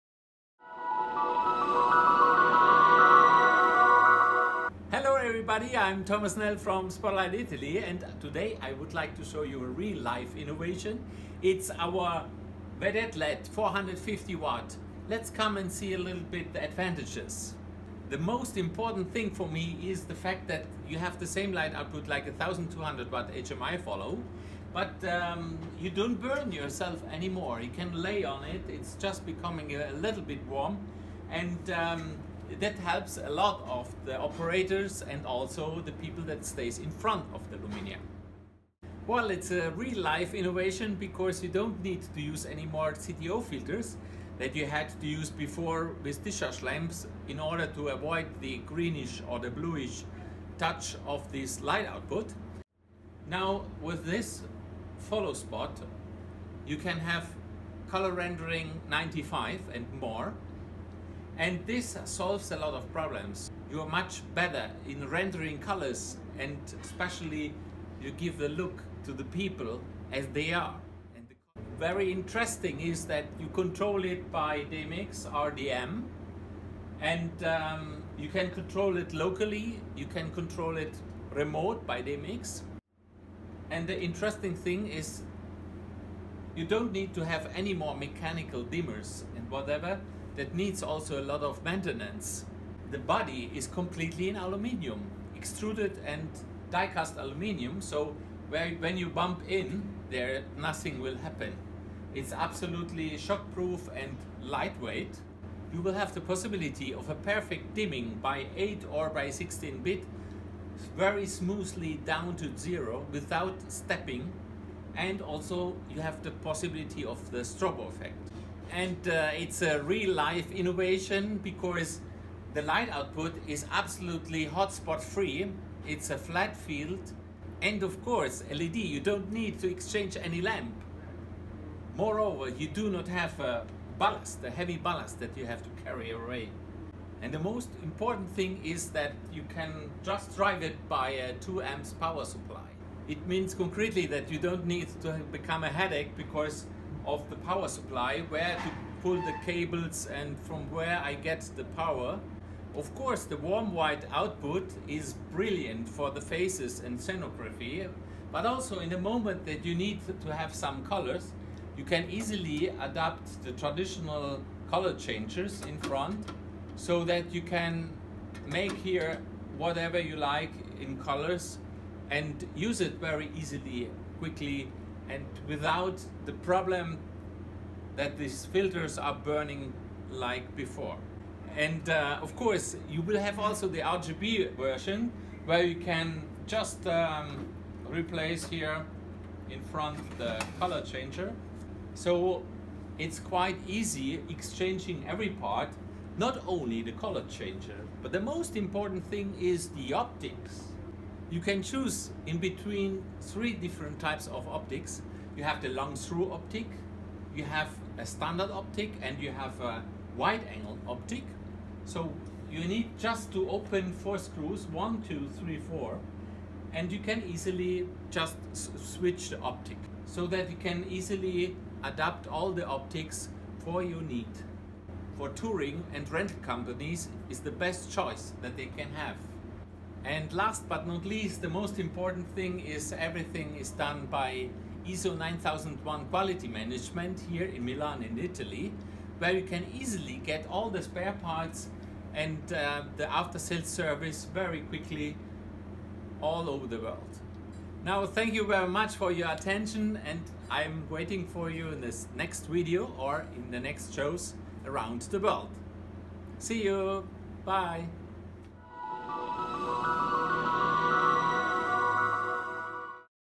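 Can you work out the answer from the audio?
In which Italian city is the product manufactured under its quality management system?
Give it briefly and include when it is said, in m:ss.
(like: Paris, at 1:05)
Milan, at 3:57.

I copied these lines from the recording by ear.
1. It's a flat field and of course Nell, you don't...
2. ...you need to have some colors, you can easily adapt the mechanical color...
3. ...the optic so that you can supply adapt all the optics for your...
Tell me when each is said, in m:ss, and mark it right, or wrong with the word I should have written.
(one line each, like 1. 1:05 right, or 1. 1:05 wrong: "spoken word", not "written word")
1. 2:05 wrong: "LED", not "Nell"
2. 2:39 wrong: "traditional", not "mechanical"
3. 3:39 wrong: "easily", not "supply".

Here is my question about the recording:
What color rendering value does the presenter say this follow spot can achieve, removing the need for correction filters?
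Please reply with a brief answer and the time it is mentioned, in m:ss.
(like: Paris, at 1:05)
95, at 0:58.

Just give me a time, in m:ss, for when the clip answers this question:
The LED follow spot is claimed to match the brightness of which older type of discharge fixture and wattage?
0:22.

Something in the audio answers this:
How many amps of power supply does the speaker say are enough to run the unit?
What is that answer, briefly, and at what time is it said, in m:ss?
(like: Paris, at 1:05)
2 amps, at 2:21.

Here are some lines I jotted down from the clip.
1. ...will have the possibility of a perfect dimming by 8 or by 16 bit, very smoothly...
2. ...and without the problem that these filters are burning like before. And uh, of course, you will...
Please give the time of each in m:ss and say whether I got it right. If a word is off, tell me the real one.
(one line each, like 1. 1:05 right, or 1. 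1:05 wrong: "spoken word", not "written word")
1. 1:45 right
2. 2:55 right.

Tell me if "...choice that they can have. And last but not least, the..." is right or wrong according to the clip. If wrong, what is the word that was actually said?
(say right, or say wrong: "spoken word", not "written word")
right.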